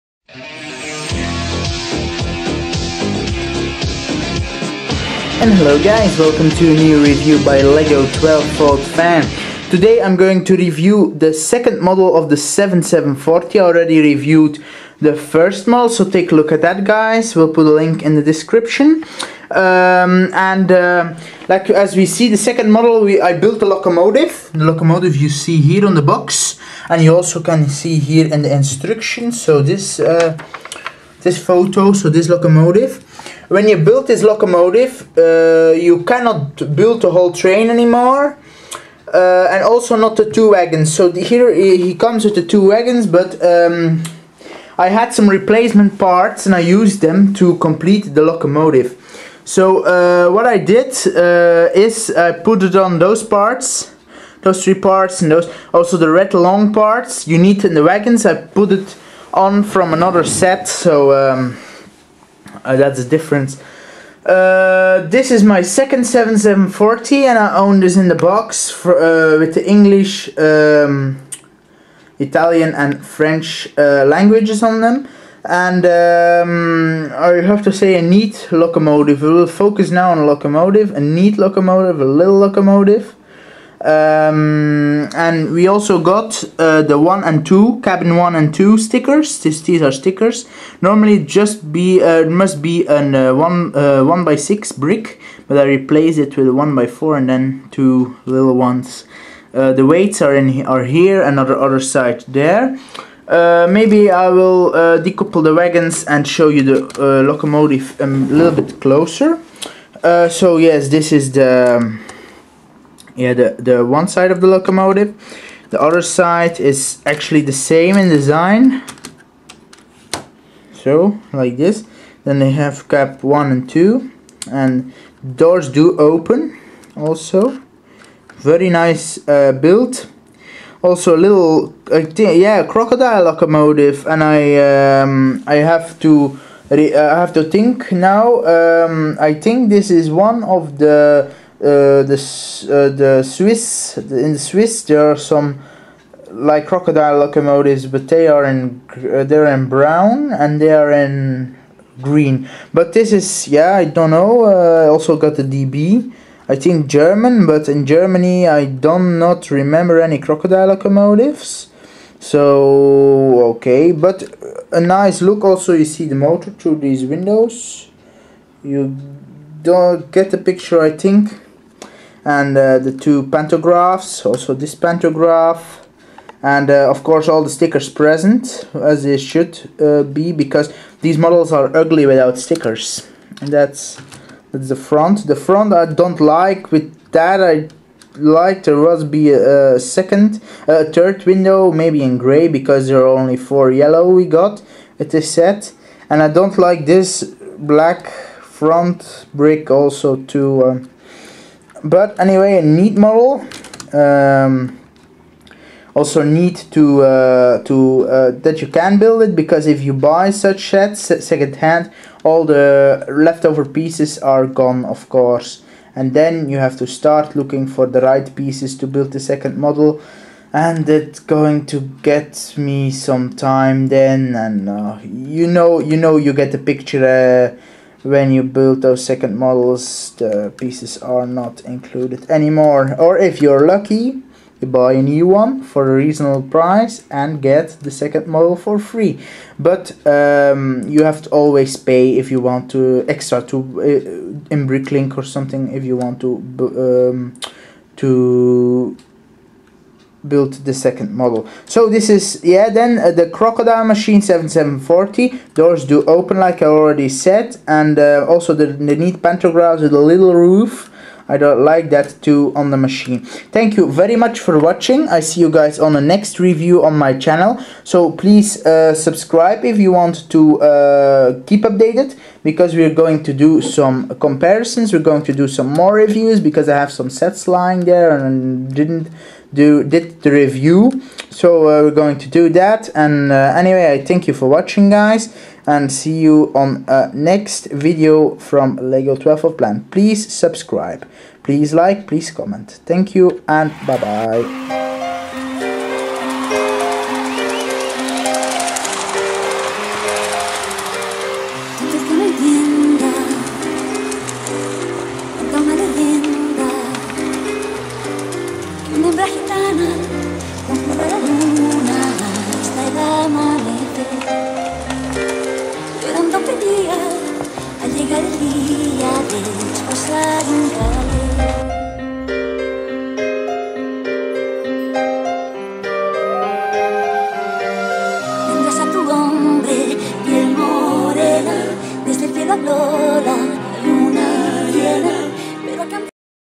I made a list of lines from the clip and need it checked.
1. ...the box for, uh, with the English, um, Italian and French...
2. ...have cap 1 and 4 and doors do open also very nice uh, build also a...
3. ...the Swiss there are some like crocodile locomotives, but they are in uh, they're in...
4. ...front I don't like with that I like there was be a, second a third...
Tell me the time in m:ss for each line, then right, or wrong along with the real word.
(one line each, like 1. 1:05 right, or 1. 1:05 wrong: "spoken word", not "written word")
1. 1:08 right
2. 2:02 wrong: "2", not "4"
3. 2:24 right
4. 3:05 right.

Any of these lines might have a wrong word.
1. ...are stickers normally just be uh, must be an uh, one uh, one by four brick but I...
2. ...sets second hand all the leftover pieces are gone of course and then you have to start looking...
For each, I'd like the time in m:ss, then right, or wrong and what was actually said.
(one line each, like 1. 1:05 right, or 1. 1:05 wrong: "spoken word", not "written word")
1. 1:29 wrong: "six", not "four"
2. 3:30 right.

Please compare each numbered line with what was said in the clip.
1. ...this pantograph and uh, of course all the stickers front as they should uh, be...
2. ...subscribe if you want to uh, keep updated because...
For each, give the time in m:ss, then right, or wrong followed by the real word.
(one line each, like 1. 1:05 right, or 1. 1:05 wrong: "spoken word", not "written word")
1. 2:54 wrong: "present", not "front"
2. 4:28 right.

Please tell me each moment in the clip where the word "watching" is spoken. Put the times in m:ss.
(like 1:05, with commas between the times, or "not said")
4:24, 4:44.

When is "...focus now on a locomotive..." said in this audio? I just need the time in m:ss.
1:19.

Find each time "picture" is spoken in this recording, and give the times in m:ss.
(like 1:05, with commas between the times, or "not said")
2:50, 3:46.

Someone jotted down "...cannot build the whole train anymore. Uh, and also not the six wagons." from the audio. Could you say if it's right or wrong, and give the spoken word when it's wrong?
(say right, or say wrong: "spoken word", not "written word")
wrong: "two", not "six".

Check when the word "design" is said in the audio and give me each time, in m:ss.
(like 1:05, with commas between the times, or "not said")
1:58.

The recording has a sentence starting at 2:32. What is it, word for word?
But this is yeah I don't know.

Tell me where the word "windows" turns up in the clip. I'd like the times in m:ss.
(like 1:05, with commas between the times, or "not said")
2:47, 3:11.